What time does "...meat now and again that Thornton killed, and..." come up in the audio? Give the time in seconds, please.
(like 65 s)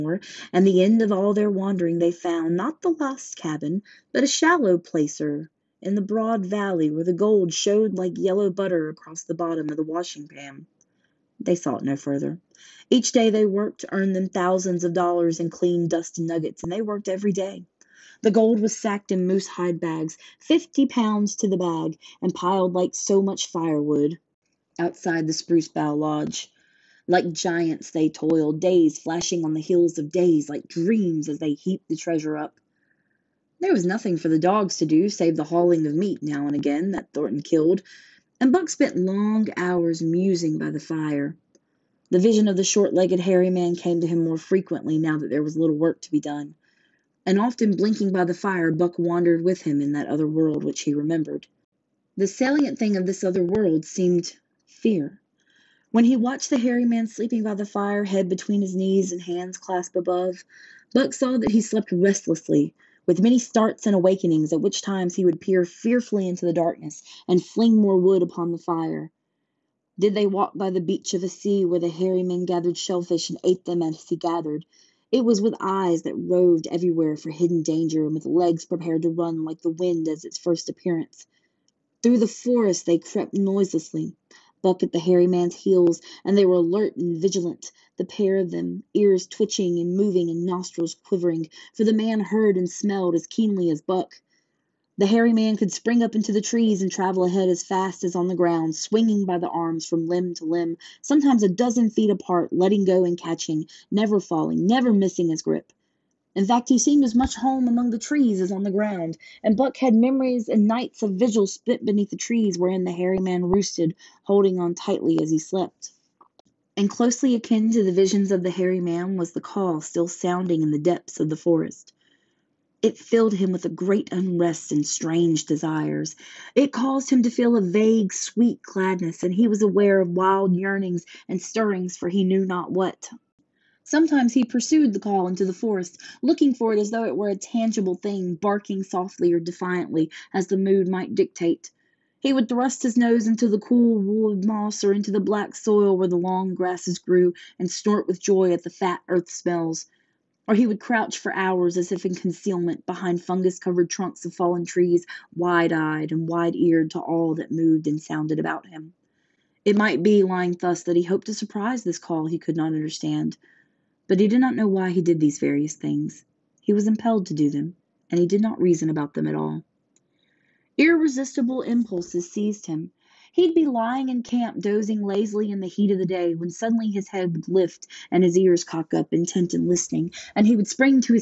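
35 s.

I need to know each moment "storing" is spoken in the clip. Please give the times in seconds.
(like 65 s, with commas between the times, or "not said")
not said.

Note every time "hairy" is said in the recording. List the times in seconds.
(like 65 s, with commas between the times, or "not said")
43 s, 56 s, 71 s, 84 s, 95 s, 112 s, 118 s.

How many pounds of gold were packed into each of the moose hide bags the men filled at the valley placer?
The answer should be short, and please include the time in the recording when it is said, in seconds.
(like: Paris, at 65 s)
50, at 20 s.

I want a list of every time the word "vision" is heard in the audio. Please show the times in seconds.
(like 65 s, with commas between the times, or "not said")
42 s, 117 s.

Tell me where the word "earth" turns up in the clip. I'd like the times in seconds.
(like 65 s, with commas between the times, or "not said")
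149 s.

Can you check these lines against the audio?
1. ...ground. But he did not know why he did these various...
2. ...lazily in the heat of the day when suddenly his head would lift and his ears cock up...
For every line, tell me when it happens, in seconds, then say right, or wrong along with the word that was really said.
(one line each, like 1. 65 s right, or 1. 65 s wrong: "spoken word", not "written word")
1. 162 s wrong: "understand", not "ground"
2. 175 s right.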